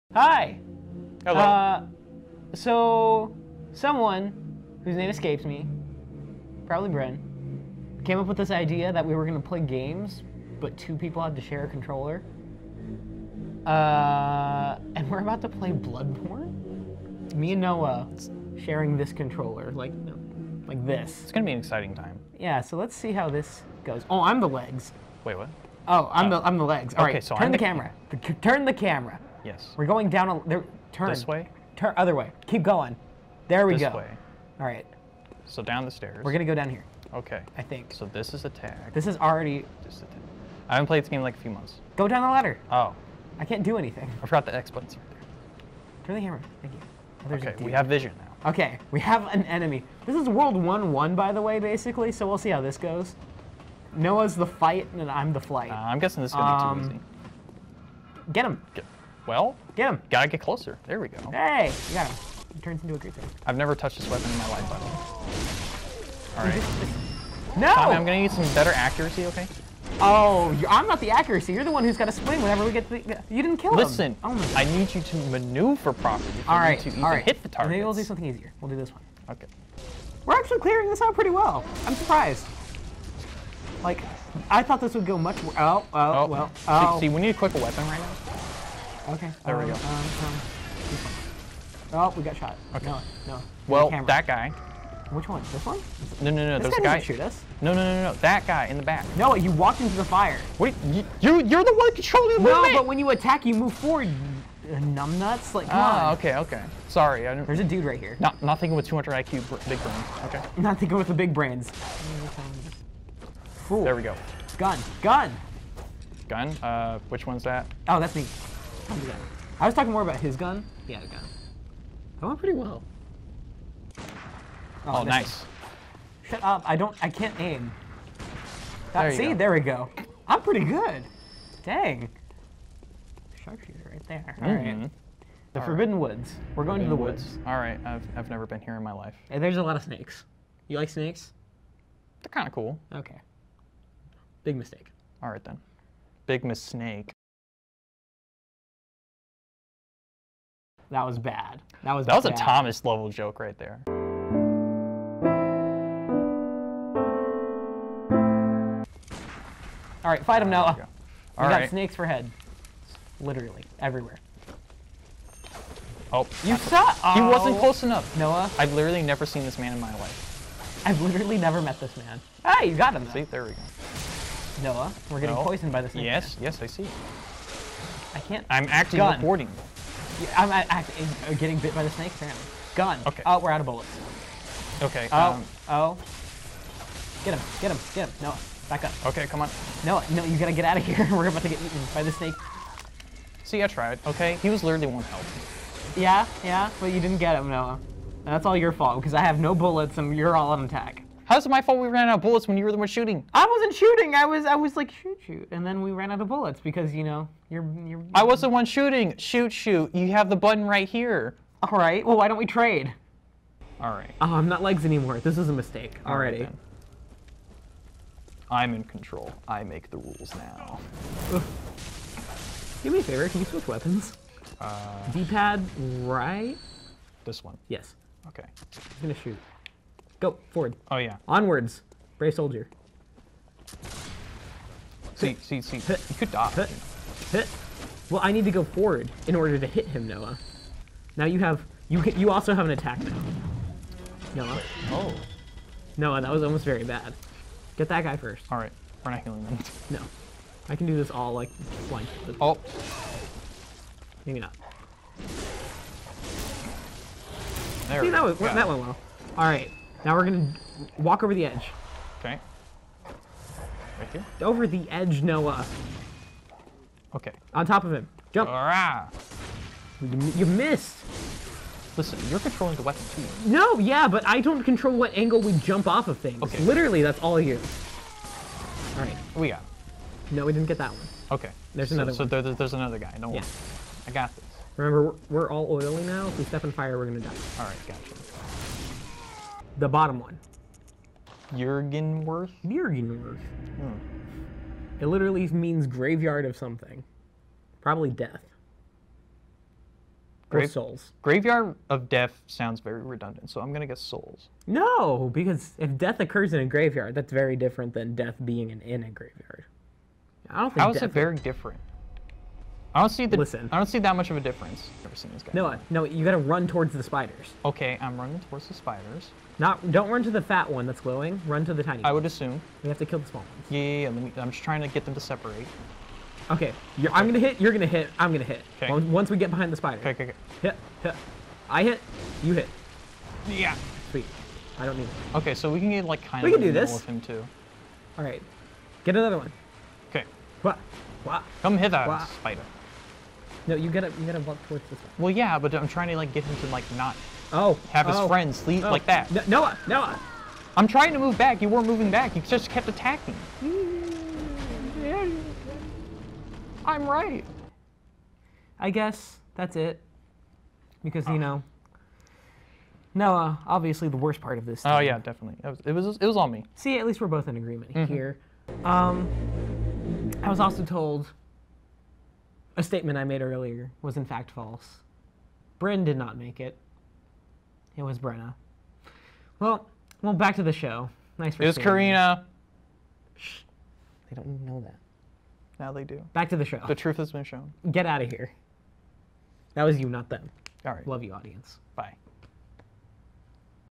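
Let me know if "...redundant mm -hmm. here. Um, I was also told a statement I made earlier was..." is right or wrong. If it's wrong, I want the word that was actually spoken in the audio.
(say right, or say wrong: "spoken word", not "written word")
wrong: "agreement", not "redundant".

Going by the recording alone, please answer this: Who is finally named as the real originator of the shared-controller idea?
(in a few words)
Brenna.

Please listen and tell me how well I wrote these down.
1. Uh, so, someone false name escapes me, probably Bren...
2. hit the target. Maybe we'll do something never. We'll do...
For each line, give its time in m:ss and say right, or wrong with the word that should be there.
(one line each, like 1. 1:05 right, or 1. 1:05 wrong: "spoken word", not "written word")
1. 0:01 wrong: "whose", not "false"
2. 1:17 wrong: "easier", not "never".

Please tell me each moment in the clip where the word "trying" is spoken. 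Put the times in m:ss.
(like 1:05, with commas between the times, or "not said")
5:24, 5:45, 5:50.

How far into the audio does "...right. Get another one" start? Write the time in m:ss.
5:38.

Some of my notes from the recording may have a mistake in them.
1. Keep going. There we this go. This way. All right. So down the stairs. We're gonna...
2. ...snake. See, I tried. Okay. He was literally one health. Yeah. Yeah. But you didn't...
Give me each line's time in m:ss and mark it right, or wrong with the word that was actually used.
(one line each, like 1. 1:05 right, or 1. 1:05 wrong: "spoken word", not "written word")
1. 0:32 right
2. 3:12 right.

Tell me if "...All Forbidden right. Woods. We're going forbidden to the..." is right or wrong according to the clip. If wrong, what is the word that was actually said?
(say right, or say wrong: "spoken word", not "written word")
right.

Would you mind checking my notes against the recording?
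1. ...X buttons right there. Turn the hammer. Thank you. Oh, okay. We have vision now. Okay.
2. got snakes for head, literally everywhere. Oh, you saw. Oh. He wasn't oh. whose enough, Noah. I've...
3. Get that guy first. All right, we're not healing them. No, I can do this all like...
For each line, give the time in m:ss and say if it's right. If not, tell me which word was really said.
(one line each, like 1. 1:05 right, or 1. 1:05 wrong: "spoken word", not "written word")
1. 0:44 right
2. 2:41 wrong: "close", not "whose"
3. 4:07 right.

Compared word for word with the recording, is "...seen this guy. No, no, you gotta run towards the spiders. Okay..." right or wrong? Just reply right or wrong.
right.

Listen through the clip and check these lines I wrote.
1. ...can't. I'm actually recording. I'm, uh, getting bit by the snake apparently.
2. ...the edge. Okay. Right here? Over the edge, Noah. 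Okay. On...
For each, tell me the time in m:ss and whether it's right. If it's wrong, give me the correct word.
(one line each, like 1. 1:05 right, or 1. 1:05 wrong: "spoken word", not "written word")
1. 2:58 right
2. 4:21 right.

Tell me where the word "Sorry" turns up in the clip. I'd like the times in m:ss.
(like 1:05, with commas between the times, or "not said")
1:46.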